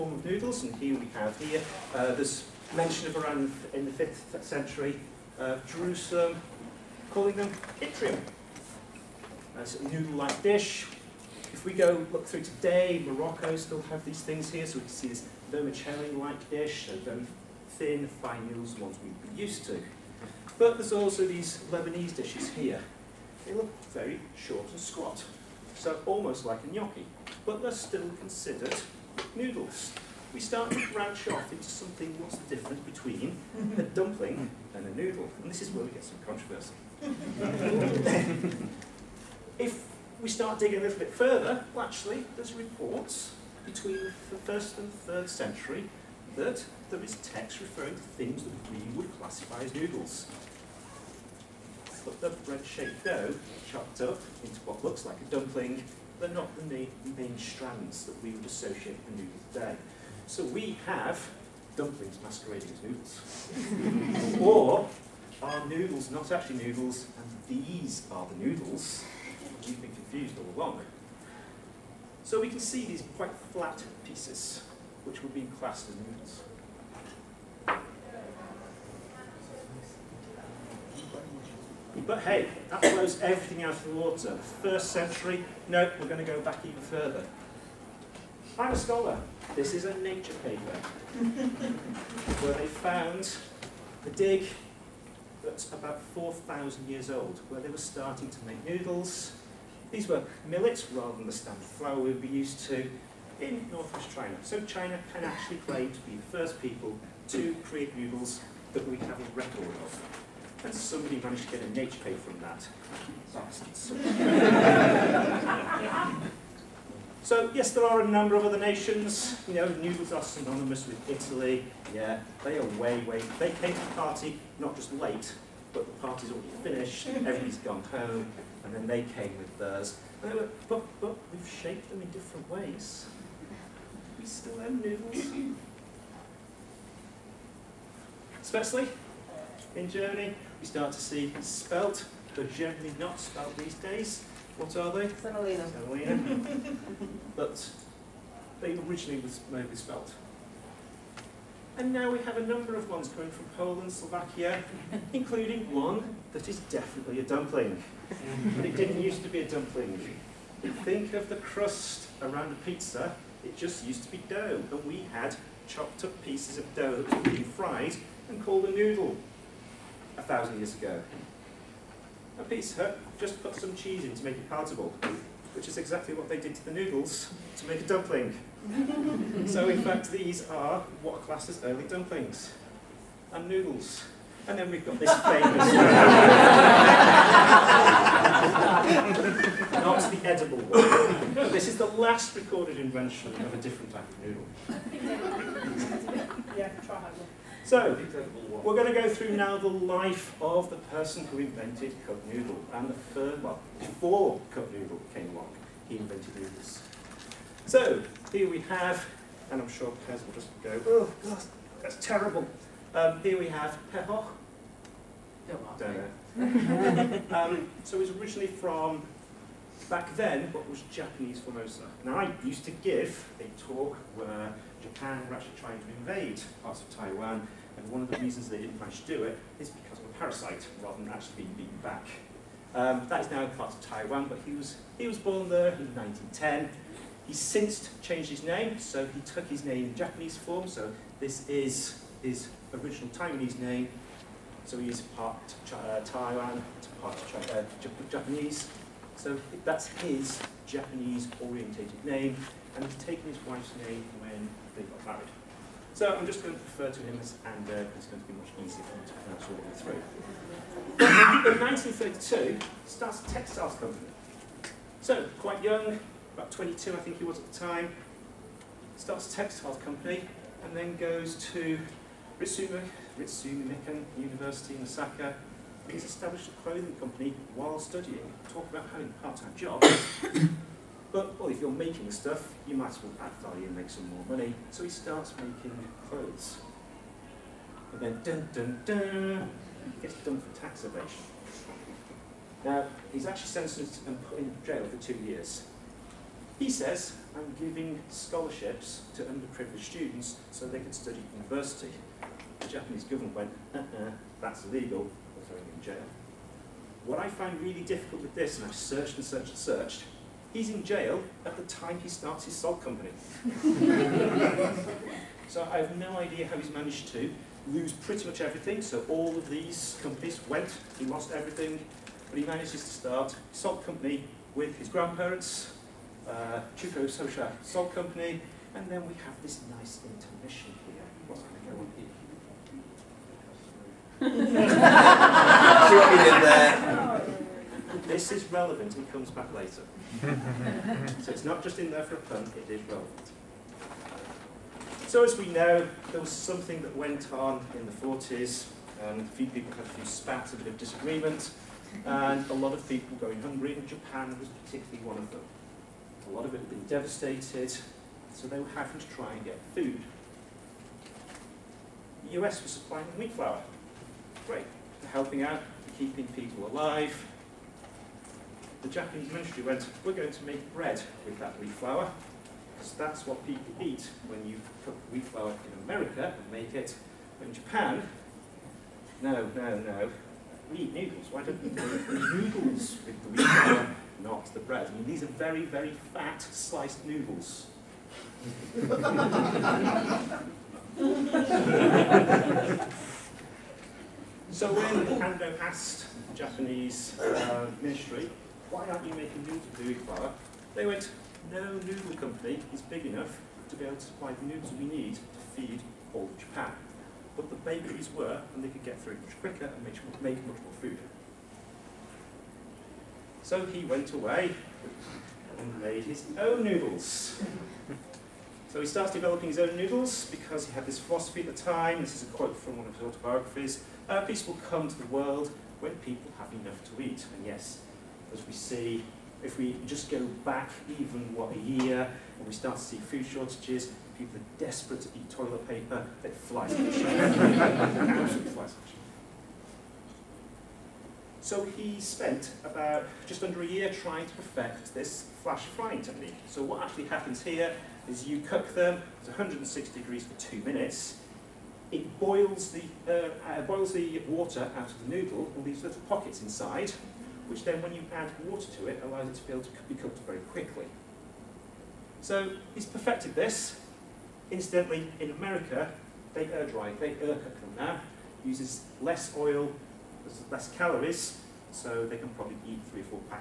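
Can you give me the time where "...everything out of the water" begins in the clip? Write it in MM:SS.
01:23.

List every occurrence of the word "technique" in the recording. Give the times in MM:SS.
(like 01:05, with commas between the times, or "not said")
07:26.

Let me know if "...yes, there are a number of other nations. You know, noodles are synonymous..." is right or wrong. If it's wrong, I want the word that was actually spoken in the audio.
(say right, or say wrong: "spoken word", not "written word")
right.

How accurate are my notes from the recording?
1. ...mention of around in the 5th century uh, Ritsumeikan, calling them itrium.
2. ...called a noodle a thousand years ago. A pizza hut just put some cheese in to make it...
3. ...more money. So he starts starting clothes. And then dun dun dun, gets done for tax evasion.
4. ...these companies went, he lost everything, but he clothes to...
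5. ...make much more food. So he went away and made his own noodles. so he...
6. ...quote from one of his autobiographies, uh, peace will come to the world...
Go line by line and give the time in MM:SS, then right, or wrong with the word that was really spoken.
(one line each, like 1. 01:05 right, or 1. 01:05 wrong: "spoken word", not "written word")
1. 00:02 wrong: "Jerusalem", not "Ritsumeikan"
2. 02:48 right
3. 04:44 wrong: "making", not "starting"
4. 05:19 wrong: "manages", not "clothes"
5. 06:50 right
6. 07:02 right.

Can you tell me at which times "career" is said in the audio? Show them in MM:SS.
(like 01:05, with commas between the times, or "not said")
not said.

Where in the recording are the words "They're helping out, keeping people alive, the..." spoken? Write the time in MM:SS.
06:05.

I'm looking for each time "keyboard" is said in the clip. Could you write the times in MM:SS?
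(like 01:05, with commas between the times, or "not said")
not said.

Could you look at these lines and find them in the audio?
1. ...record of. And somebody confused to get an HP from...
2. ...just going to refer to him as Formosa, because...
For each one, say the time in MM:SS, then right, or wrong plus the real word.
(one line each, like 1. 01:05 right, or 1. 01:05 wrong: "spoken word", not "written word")
1. 01:49 wrong: "managed", not "confused"
2. 04:16 wrong: "Ando", not "Formosa".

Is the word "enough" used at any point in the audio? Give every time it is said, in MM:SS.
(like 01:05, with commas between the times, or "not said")
06:43, 07:06.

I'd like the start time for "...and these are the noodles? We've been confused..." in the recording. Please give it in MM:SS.
01:07.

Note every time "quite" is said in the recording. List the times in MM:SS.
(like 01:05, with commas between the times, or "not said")
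01:13, 04:25.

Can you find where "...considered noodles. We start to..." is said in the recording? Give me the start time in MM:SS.
00:28.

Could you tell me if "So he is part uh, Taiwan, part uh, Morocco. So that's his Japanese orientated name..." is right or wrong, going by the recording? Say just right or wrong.
wrong.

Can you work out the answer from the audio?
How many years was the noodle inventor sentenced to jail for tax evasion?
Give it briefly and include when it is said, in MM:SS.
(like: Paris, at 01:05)
2 years, at 04:55.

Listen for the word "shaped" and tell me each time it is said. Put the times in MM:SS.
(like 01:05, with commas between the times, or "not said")
00:52, 02:11.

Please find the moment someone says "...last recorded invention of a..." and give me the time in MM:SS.
03:11.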